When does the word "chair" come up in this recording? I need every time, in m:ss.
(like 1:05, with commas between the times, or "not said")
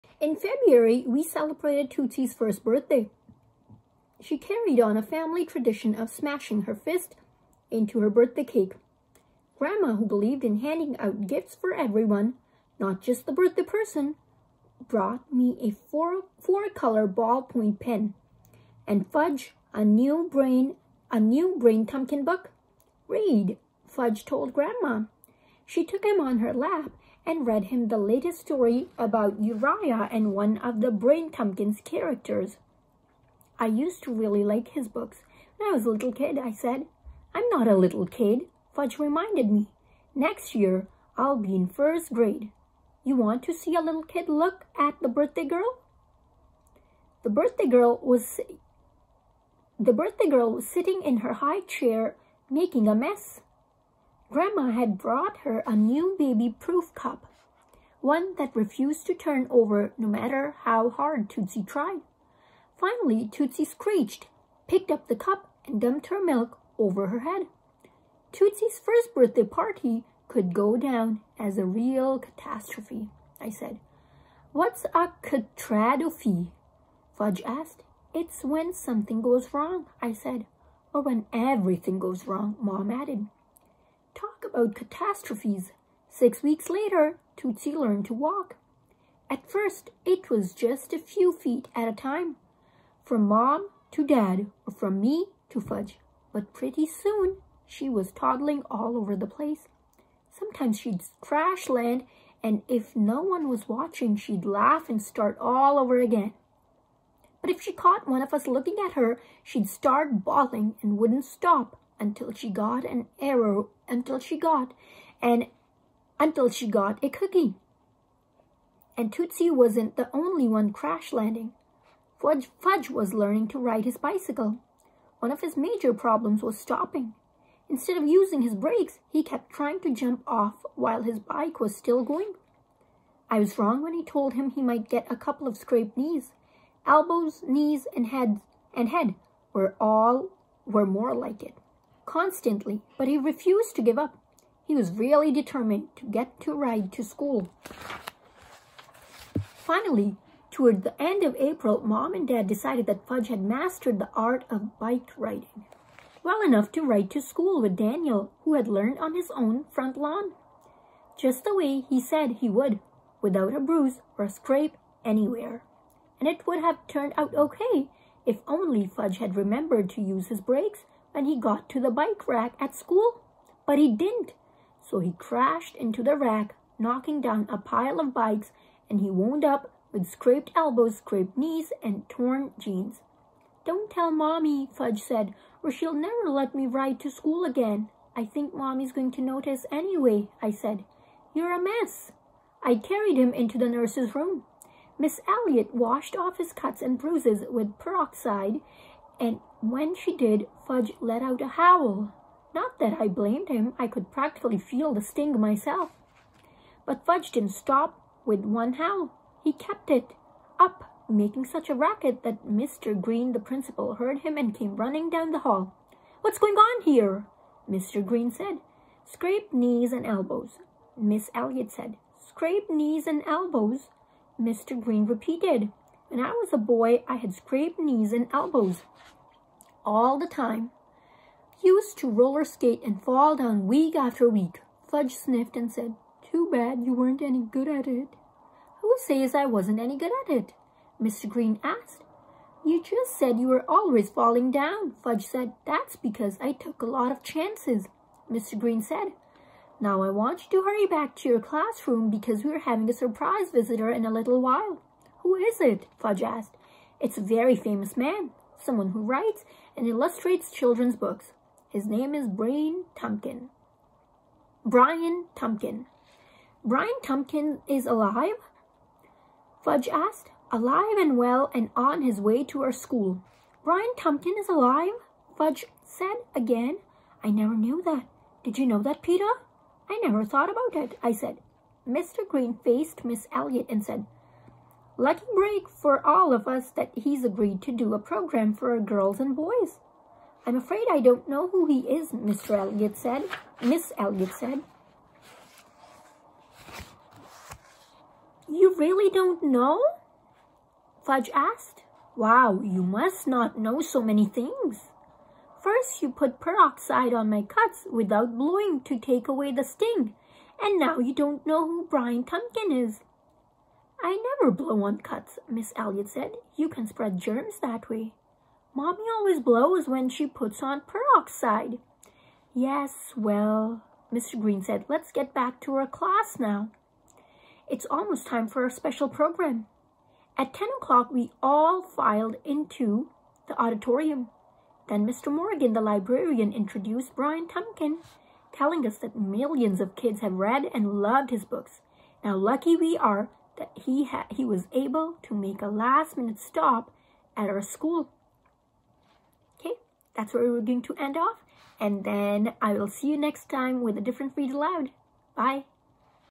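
0:51.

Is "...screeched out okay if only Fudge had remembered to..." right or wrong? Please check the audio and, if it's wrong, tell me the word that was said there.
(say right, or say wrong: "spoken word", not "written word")
wrong: "turned", not "screeched".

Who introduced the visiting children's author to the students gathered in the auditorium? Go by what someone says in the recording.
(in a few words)
Mr. Morgan.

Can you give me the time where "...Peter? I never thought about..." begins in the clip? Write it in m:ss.
4:39.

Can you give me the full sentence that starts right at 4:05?
That's because I took a lot of chances, Mr.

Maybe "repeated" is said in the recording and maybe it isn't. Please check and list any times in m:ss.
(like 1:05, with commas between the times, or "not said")
3:45.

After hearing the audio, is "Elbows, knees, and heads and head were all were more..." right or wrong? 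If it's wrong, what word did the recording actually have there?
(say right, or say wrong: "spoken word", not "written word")
right.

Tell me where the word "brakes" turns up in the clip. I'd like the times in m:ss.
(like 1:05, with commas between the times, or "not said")
2:08, 2:50.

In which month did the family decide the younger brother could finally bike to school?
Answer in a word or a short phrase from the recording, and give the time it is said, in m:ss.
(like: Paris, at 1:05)
April, at 2:31.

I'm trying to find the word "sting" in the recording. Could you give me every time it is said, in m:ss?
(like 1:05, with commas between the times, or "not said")
3:25, 5:09.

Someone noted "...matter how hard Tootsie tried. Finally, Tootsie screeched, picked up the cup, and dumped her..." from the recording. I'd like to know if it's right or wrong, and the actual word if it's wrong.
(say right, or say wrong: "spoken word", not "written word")
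right.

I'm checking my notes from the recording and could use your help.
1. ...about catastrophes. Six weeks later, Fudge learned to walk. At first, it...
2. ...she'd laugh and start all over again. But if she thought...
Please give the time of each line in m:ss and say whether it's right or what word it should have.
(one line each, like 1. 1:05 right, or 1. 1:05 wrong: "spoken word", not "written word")
1. 1:24 wrong: "Tootsie", not "Fudge"
2. 1:44 wrong: "caught", not "thought".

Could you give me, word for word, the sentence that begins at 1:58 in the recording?
And Tootsie wasn't the only one crash landing.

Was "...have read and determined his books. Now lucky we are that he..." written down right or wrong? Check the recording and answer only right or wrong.
wrong.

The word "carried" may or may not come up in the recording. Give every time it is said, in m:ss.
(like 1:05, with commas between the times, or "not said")
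0:04, 3:12.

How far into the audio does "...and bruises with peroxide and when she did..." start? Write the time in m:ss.
3:16.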